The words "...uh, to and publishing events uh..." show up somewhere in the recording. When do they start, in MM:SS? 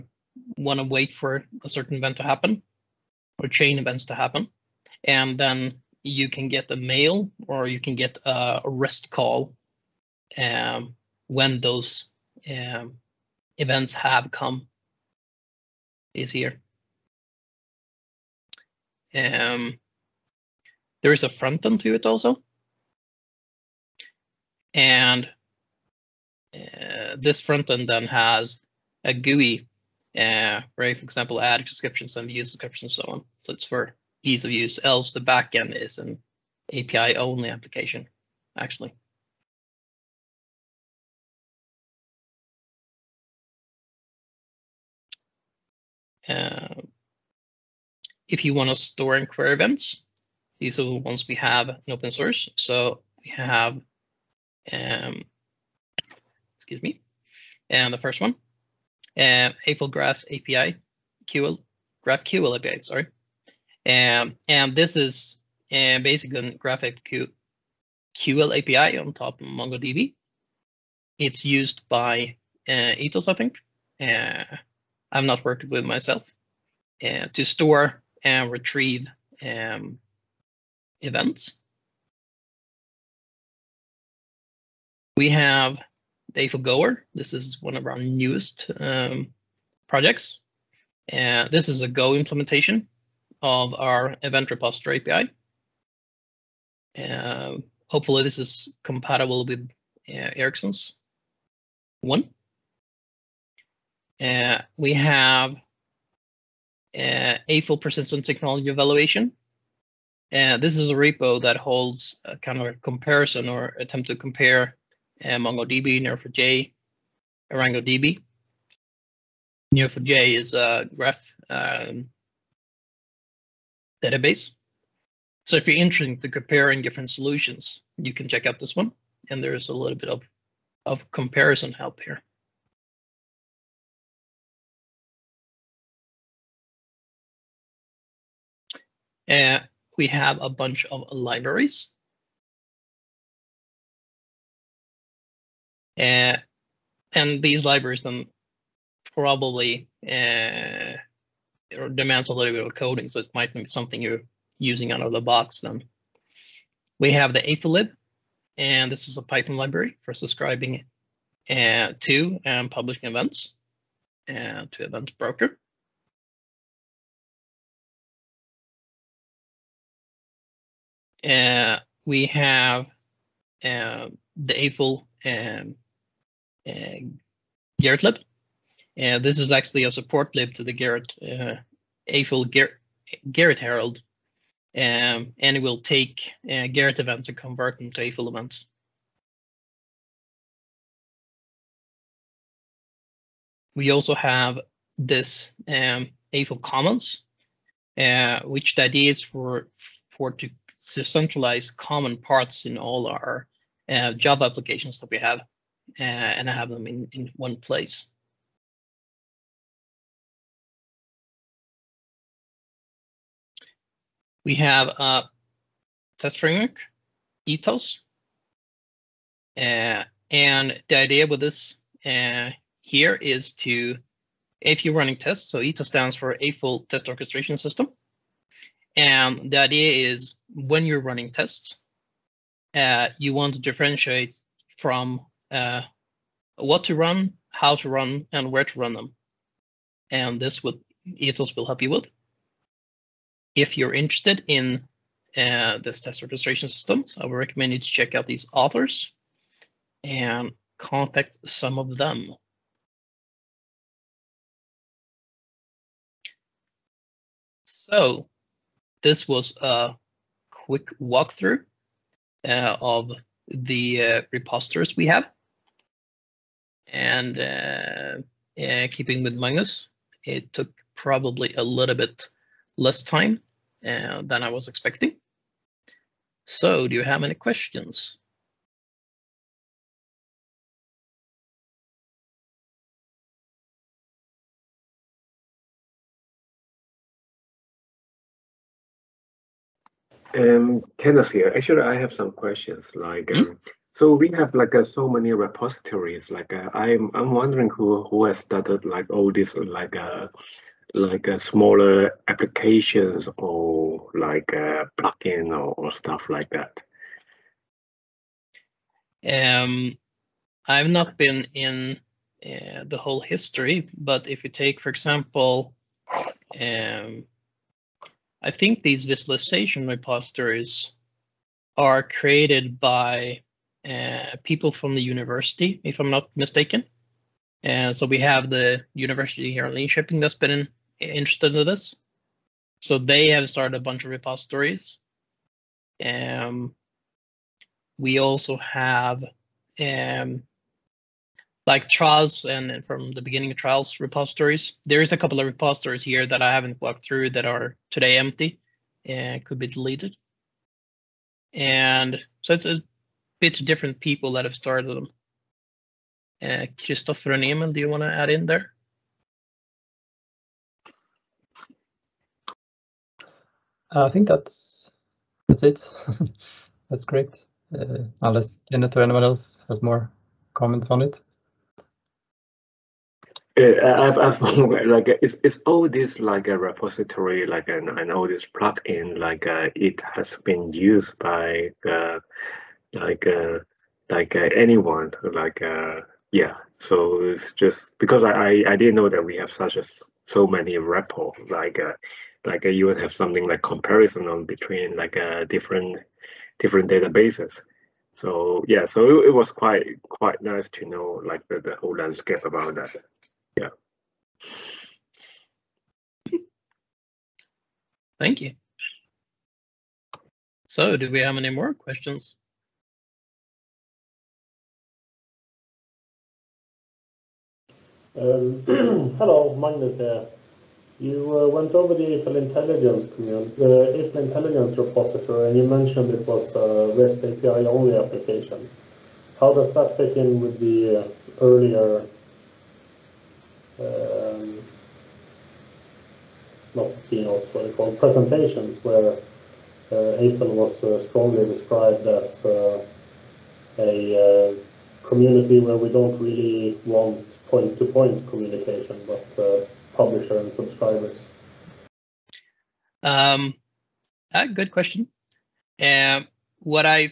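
02:41.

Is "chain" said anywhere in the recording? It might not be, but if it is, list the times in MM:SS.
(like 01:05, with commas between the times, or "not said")
00:03.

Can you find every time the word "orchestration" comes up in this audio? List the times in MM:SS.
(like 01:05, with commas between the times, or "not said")
03:47.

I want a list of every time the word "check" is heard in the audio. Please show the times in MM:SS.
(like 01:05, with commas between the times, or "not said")
02:08, 04:07.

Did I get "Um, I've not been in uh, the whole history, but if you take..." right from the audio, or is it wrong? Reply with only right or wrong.
right.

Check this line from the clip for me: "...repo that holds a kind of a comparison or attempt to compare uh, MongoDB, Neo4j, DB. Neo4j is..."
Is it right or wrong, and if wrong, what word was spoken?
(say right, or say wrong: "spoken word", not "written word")
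right.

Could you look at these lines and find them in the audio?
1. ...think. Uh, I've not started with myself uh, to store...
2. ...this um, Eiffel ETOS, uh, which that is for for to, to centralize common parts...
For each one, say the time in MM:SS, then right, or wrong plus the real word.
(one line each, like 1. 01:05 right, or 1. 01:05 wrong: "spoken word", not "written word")
1. 01:13 wrong: "worked", not "started"
2. 03:14 wrong: "Commons", not "ETOS".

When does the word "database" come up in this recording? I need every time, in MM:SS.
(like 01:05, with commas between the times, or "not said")
02:04, 06:36.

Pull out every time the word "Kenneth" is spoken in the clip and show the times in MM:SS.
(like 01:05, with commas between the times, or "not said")
04:50, 06:08.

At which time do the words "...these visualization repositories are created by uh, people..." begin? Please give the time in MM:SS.
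05:18.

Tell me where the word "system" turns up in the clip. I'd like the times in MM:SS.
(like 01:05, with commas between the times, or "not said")
03:47, 04:06.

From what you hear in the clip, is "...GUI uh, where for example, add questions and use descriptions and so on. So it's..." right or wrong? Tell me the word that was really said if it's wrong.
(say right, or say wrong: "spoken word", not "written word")
wrong: "descriptions", not "questions".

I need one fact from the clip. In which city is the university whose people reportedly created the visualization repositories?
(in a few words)
Linköping.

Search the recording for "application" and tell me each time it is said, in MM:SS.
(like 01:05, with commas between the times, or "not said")
00:37, 03:24, 05:02, 07:07.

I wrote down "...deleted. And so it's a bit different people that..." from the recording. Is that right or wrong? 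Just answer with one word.
right.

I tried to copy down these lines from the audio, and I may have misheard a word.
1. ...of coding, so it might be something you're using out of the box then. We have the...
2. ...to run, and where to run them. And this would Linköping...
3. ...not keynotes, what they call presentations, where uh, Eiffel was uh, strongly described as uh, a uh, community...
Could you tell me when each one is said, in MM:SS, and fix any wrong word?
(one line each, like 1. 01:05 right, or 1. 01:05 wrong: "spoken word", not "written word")
1. 02:32 right
2. 03:57 wrong: "ETOS", not "Linköping"
3. 07:16 right.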